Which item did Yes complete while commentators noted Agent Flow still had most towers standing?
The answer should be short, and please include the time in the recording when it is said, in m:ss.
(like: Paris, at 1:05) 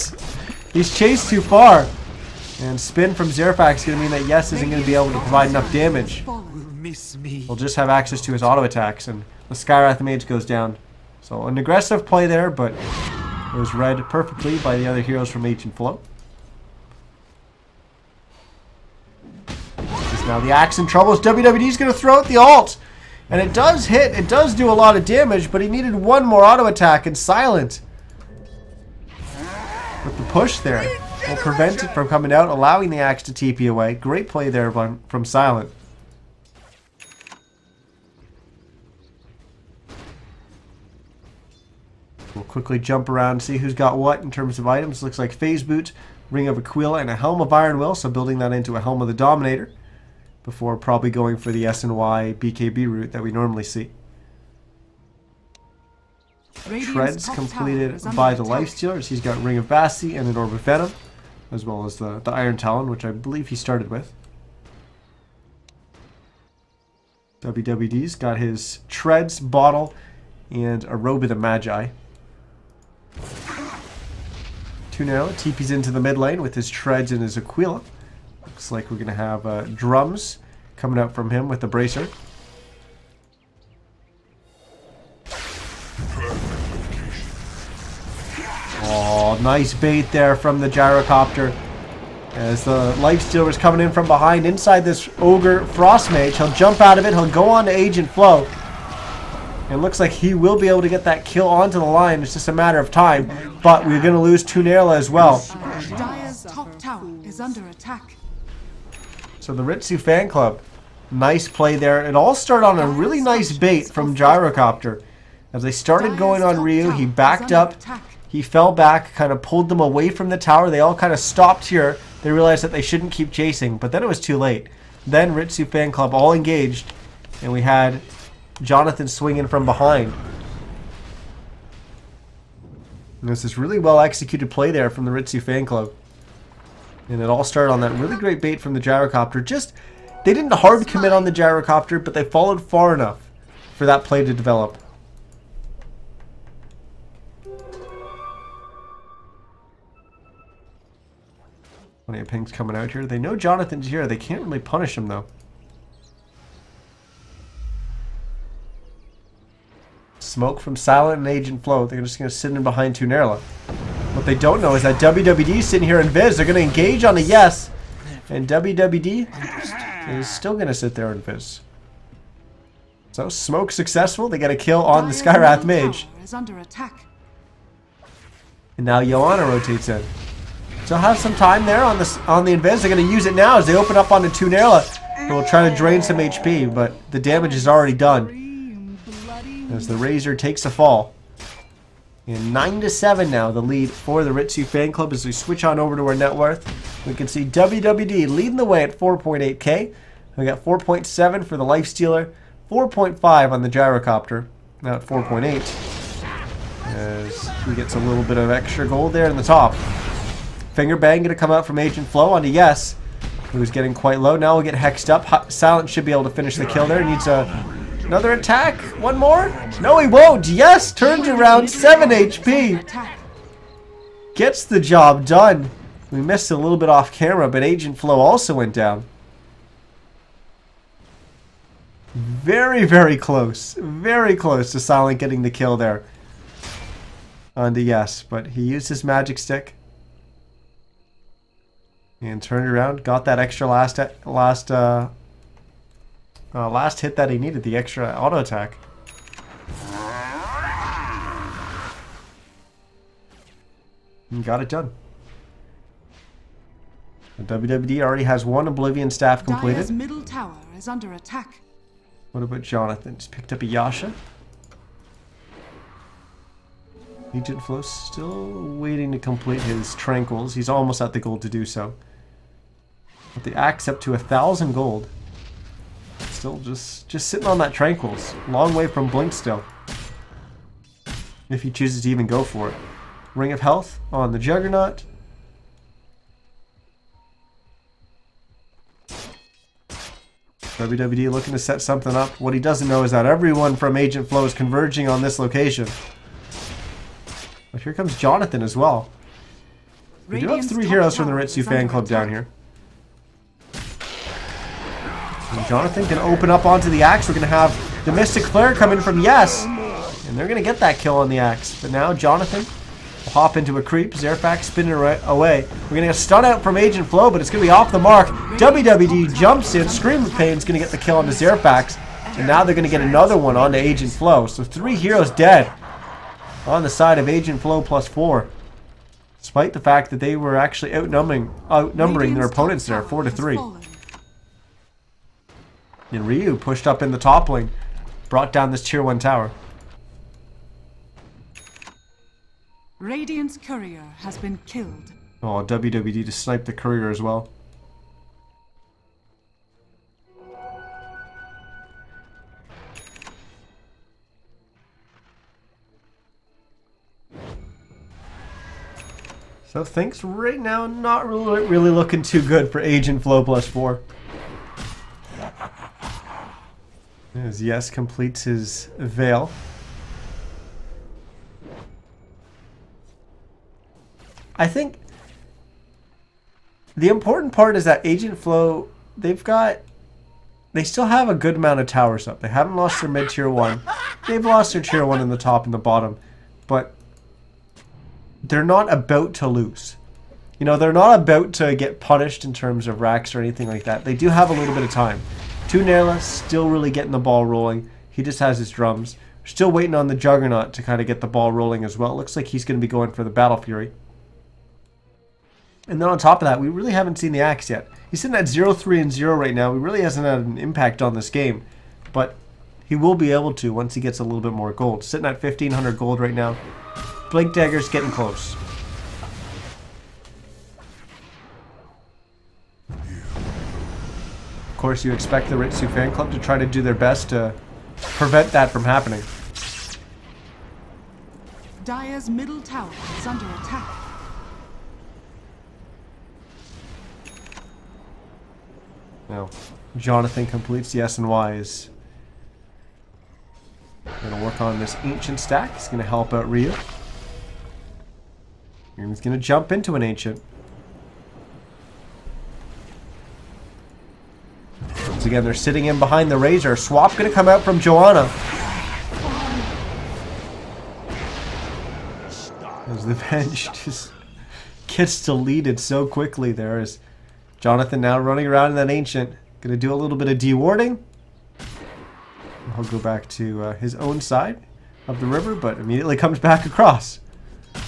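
Veil, at 6:08.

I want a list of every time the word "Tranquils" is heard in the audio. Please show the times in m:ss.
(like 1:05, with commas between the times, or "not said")
4:29, 4:37.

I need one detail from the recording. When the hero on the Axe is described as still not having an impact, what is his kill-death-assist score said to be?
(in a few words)
0-3-0.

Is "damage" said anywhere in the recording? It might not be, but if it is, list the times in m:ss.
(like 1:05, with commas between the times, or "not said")
0:05, 0:25, 3:07.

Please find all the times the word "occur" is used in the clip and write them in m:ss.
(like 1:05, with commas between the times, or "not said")
not said.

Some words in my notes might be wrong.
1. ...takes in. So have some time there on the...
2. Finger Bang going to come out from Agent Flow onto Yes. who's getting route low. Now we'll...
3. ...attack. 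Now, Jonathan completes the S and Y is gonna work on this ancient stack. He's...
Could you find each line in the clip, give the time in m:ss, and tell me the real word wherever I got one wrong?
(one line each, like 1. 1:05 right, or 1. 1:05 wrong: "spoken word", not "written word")
1. 2:59 wrong: "rotates", not "takes"
2. 3:30 wrong: "quite", not "route"
3. 7:13 right.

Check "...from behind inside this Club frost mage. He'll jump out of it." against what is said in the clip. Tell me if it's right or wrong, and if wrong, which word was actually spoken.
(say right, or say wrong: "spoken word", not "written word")
wrong: "Ogre", not "Club".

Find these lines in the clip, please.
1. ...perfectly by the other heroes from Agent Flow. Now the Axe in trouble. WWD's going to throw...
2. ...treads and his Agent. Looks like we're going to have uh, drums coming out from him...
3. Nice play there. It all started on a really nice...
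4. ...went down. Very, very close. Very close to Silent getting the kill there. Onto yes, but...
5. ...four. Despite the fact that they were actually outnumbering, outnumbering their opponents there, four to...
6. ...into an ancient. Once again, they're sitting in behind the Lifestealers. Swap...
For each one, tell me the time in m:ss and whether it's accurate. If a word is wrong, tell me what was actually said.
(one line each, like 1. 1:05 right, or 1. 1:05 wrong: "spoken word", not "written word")
1. 0:14 right
2. 1:16 wrong: "Aquila", not "Agent"
3. 1:51 right
4. 3:48 right
5. 5:28 right
6. 7:29 wrong: "Razor", not "Lifestealers".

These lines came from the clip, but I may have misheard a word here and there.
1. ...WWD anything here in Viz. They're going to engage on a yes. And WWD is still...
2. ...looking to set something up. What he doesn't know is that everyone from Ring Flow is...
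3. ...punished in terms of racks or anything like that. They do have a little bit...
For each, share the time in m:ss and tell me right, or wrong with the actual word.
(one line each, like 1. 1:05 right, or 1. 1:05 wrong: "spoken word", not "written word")
1. 2:44 wrong: "sitting", not "anything"
2. 4:51 wrong: "Agent", not "Ring"
3. 6:31 right.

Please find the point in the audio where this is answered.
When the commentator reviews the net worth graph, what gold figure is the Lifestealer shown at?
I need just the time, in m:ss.
3:20.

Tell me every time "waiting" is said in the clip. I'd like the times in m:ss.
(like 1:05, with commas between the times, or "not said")
4:28, 6:39.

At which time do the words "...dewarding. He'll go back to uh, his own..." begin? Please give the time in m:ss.
7:50.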